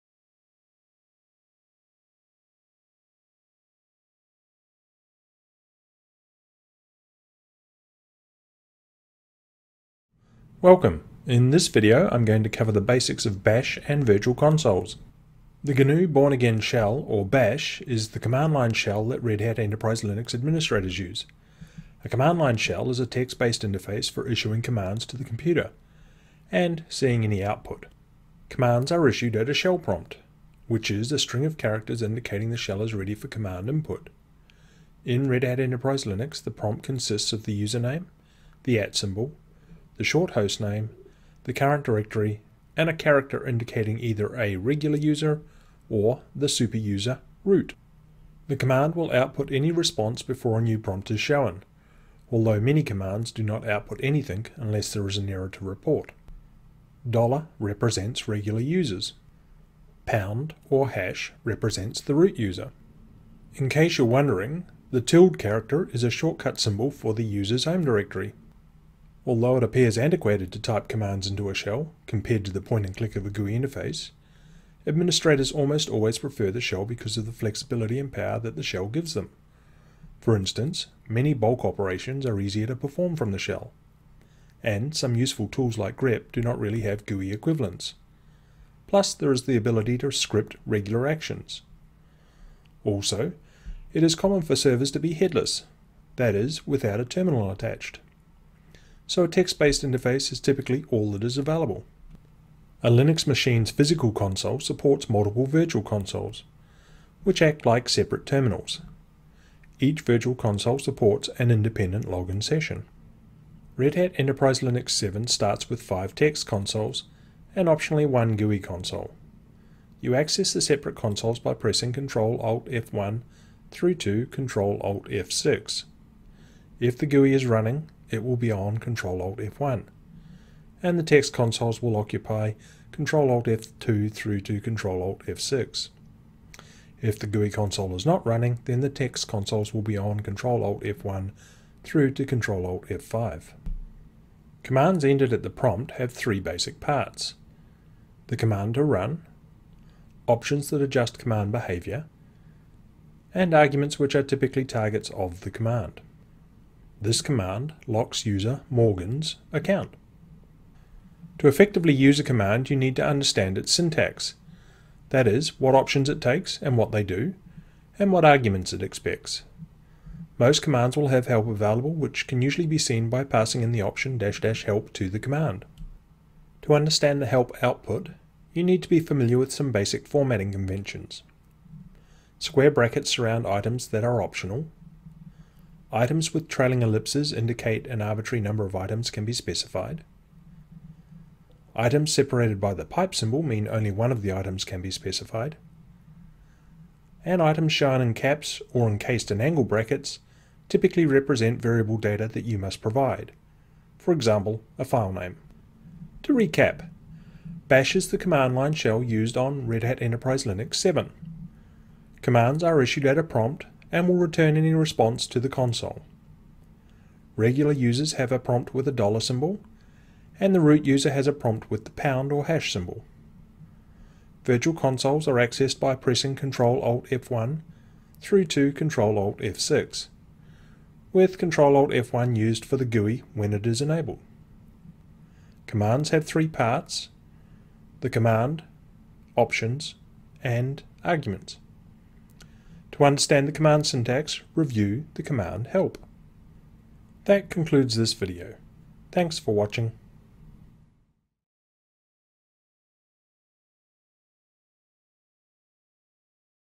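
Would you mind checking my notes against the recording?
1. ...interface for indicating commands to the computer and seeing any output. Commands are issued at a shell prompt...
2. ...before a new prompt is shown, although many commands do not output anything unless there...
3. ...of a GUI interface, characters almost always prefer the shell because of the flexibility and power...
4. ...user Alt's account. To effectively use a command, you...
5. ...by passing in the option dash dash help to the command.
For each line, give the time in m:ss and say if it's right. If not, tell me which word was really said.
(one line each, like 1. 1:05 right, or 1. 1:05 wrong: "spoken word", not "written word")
1. 0:23 wrong: "issuing", not "indicating"
2. 0:50 right
3. 1:13 wrong: "administrators", not "characters"
4. 2:38 wrong: "Morgan", not "Alt"
5. 2:53 right.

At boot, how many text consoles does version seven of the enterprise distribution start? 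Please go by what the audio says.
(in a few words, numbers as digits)
5.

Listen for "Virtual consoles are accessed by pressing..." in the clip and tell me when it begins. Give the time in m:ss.
3:44.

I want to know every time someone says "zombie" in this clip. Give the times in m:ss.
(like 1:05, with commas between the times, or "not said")
not said.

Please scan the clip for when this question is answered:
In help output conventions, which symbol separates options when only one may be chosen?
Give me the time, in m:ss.
3:12.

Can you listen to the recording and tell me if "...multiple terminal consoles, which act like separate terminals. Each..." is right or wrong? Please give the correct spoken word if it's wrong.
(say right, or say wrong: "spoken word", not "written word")
wrong: "virtual", not "terminal".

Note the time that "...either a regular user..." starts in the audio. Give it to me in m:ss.
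0:43.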